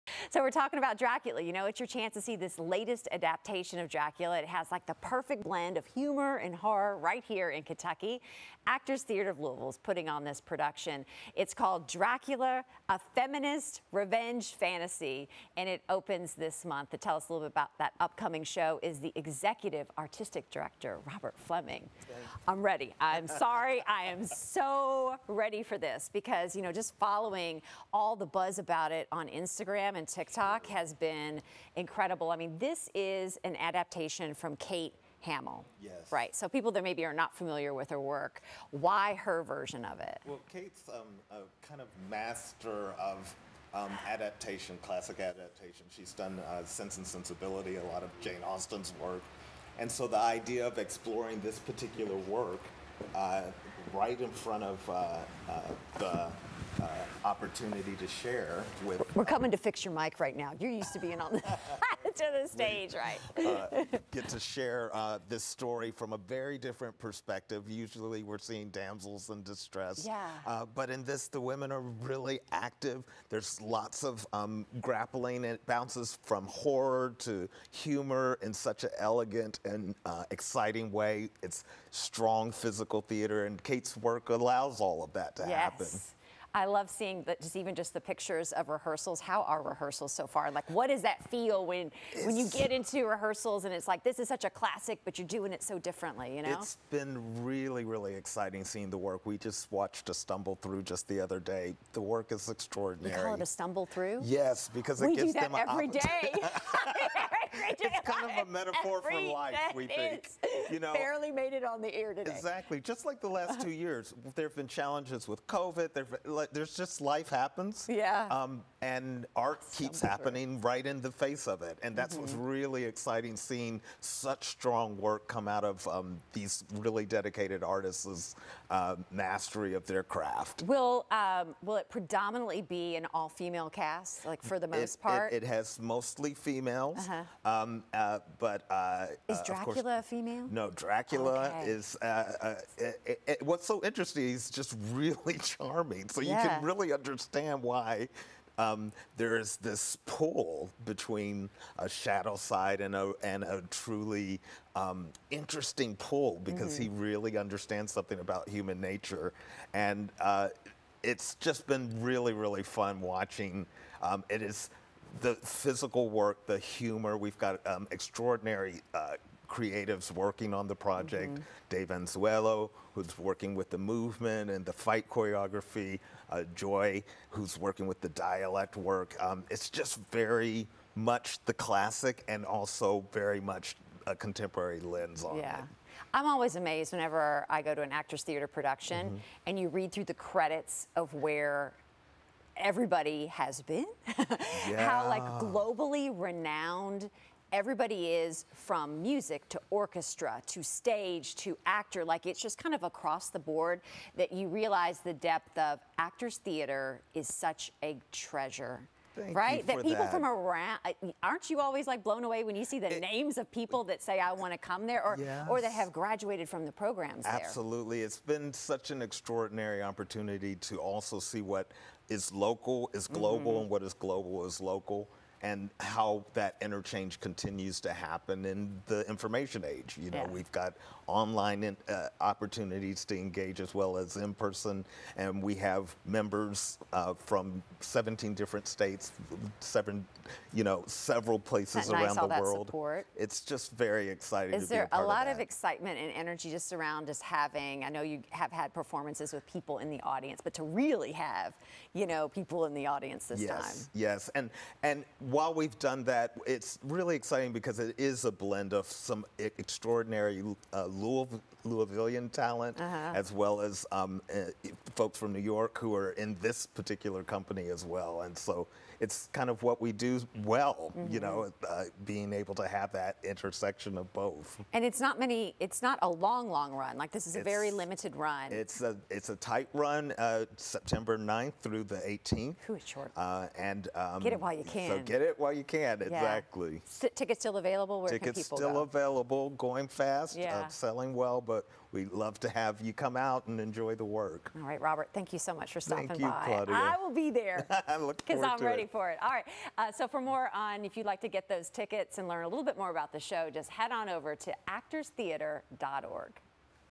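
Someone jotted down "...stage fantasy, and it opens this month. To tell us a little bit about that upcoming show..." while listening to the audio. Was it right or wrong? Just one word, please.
wrong.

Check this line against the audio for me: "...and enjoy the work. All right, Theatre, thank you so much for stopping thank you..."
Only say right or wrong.
wrong.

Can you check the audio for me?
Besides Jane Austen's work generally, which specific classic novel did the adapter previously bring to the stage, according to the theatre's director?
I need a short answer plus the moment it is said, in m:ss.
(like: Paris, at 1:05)
Sense and Sensibility, at 0:46.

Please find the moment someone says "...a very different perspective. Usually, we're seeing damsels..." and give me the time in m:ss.
1:06.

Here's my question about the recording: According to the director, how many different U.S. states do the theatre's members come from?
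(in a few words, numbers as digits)
17.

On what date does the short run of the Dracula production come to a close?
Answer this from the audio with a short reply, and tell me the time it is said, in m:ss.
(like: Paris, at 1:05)
September 18, at 4:41.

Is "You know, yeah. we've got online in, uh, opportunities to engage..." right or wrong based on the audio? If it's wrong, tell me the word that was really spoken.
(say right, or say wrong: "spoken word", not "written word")
right.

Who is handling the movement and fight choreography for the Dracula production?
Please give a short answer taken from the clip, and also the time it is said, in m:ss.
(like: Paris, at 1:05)
Dave Anzuelo, at 2:51.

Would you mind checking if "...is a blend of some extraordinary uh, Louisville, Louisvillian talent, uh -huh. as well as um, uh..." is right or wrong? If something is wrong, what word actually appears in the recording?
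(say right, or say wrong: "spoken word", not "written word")
right.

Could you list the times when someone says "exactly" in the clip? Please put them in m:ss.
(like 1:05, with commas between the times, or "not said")
1:52, 4:46.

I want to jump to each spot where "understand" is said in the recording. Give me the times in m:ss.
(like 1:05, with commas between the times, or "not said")
2:26, 2:37.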